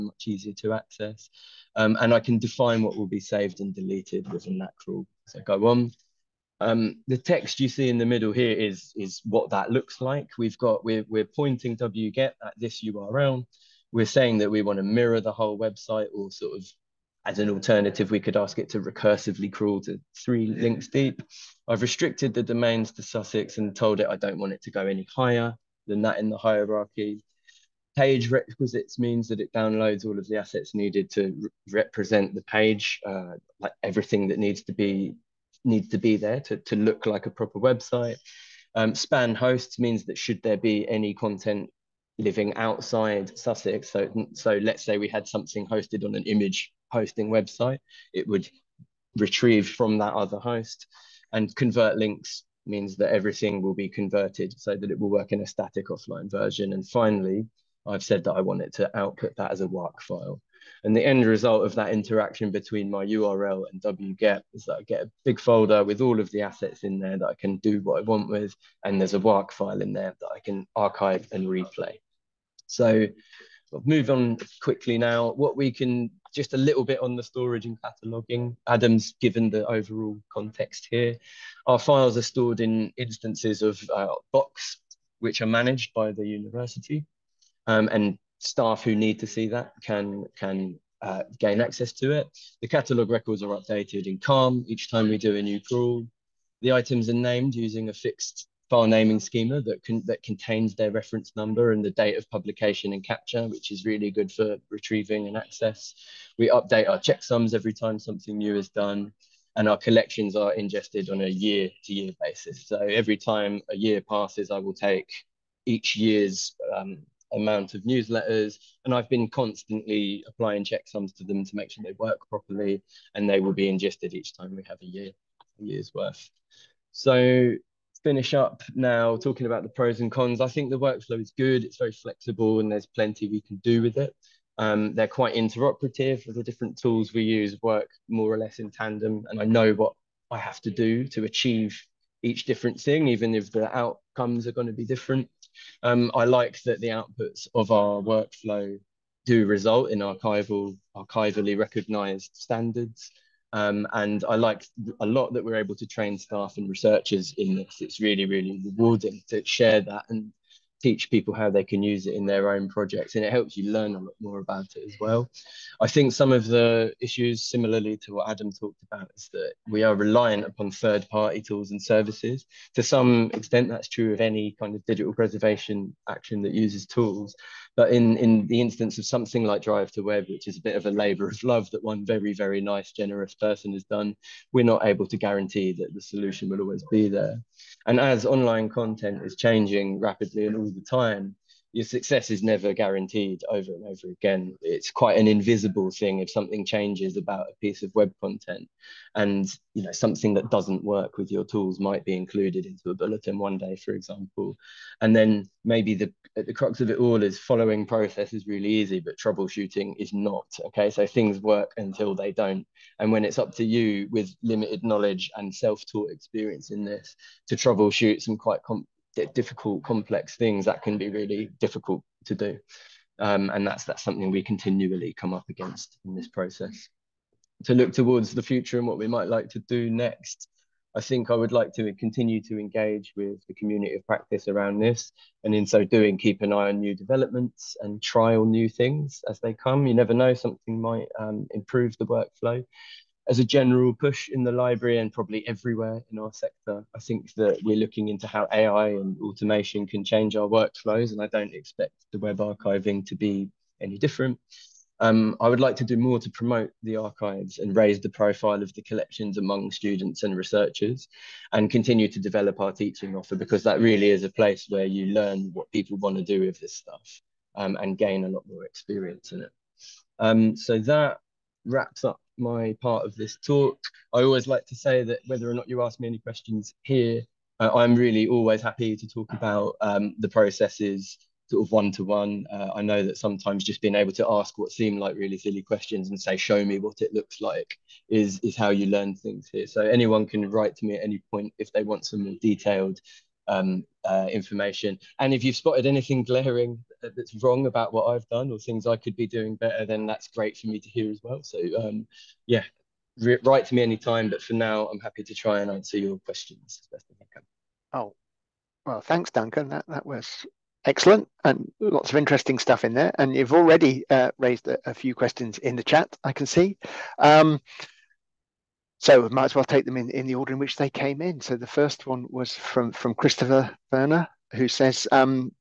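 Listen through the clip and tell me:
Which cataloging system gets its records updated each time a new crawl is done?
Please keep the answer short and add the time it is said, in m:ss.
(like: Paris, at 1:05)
Calm, at 1:34.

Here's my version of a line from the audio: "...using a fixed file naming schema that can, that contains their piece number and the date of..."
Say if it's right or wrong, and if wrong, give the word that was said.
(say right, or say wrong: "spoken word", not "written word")
wrong: "reference", not "piece".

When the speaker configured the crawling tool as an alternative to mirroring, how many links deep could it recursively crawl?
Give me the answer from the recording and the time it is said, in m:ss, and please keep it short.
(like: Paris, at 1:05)
3, at 0:20.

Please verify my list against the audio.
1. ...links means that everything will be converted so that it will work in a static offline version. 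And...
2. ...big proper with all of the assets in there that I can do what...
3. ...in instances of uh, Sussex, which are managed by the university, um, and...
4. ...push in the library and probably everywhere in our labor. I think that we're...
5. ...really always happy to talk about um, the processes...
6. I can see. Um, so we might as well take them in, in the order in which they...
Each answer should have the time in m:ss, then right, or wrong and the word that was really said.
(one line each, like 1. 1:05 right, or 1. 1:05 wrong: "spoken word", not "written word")
1. 0:51 right
2. 1:05 wrong: "folder", not "proper"
3. 1:22 wrong: "Box", not "Sussex"
4. 4:03 wrong: "sector", not "labor"
5. 4:37 right
6. 5:16 right.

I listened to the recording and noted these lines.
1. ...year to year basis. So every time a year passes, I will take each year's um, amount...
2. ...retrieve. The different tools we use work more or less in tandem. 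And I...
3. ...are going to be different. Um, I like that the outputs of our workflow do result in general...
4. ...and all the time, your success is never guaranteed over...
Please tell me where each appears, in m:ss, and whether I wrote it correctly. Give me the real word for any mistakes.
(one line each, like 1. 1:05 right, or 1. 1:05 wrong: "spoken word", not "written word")
1. 1:51 right
2. 2:15 wrong: "interoperative", not "retrieve"
3. 2:24 wrong: "archival", not "general"
4. 3:10 right.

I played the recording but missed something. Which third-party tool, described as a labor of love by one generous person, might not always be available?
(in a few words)
Drive to Web.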